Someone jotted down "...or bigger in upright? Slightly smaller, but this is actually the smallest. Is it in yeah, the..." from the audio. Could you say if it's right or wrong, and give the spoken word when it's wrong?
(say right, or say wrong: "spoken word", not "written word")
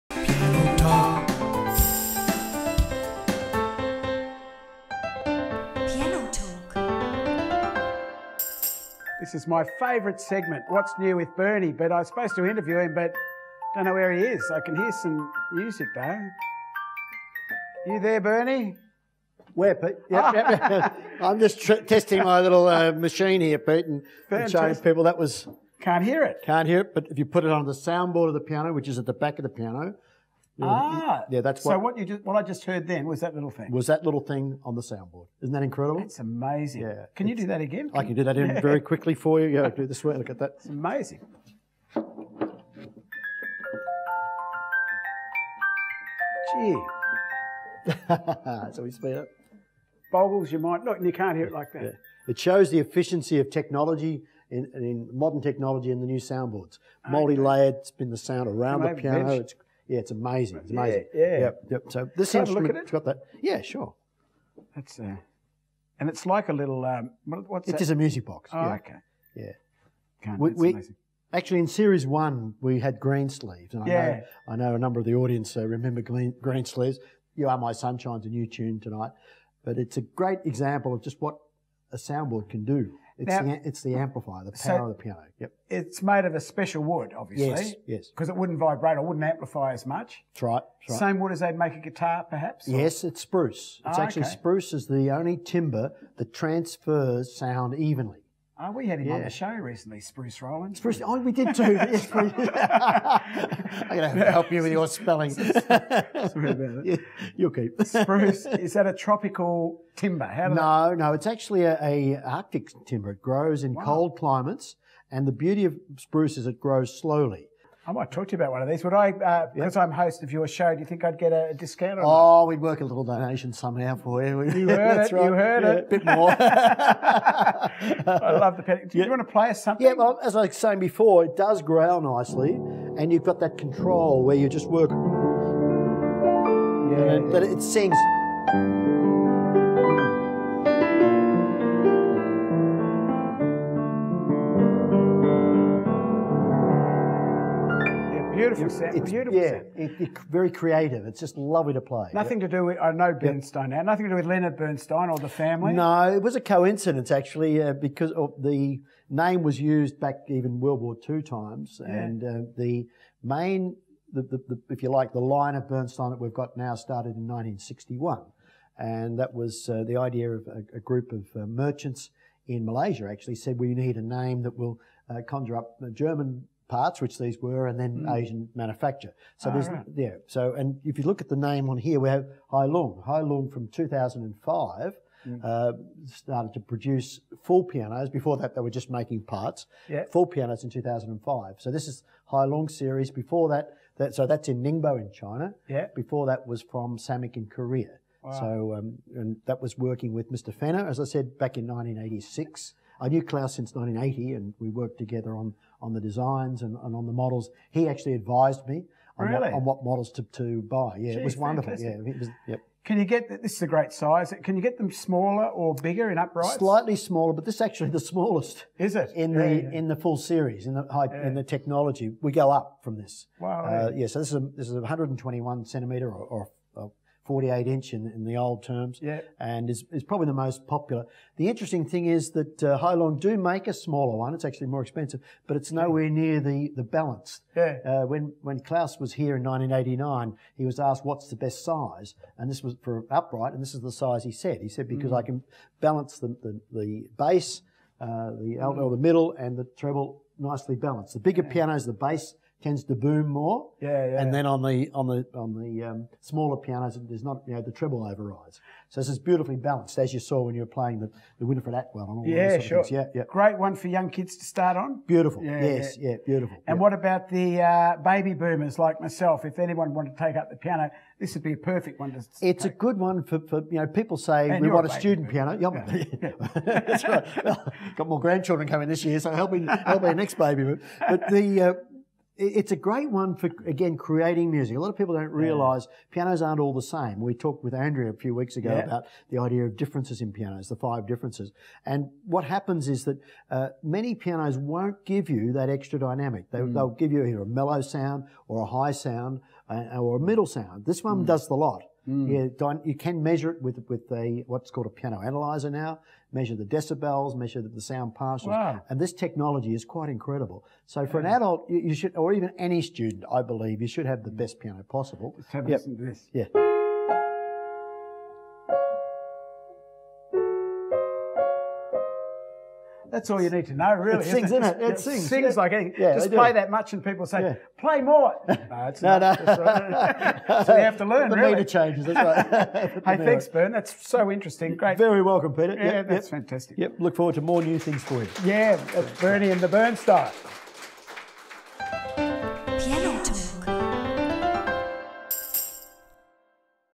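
right.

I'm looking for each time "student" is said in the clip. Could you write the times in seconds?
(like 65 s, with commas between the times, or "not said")
274 s, 312 s.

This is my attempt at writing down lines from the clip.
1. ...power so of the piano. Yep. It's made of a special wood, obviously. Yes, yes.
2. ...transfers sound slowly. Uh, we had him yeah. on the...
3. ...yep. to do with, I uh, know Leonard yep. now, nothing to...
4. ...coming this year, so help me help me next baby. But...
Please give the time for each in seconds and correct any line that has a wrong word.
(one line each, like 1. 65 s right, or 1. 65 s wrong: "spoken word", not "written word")
1. 84 s right
2. 96 s wrong: "evenly", not "slowly"
3. 152 s wrong: "Bernstein", not "Leonard"
4. 278 s right.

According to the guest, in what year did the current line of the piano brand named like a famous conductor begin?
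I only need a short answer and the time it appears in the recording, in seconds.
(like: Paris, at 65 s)
1961, at 167 s.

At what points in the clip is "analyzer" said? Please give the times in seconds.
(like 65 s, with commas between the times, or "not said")
305 s.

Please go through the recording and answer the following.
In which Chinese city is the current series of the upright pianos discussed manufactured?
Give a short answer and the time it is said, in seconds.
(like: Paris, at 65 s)
Ningbo, at 194 s.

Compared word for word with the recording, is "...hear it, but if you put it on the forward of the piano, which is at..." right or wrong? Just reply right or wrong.
wrong.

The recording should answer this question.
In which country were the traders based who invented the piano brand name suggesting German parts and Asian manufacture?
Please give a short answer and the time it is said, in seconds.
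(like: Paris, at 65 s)
Malaysia, at 172 s.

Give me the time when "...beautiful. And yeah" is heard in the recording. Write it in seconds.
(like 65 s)
266 s.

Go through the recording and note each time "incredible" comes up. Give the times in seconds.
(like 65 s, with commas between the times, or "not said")
35 s, 310 s.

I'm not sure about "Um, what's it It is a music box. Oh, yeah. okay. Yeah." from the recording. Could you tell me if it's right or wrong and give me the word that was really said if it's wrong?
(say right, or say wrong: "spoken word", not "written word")
right.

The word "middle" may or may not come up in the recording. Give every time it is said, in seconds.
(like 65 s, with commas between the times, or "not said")
248 s, 300 s.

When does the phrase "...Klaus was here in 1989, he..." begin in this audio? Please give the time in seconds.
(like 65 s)
238 s.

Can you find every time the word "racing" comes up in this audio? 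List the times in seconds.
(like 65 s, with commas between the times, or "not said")
not said.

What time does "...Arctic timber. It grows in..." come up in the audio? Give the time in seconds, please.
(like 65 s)
112 s.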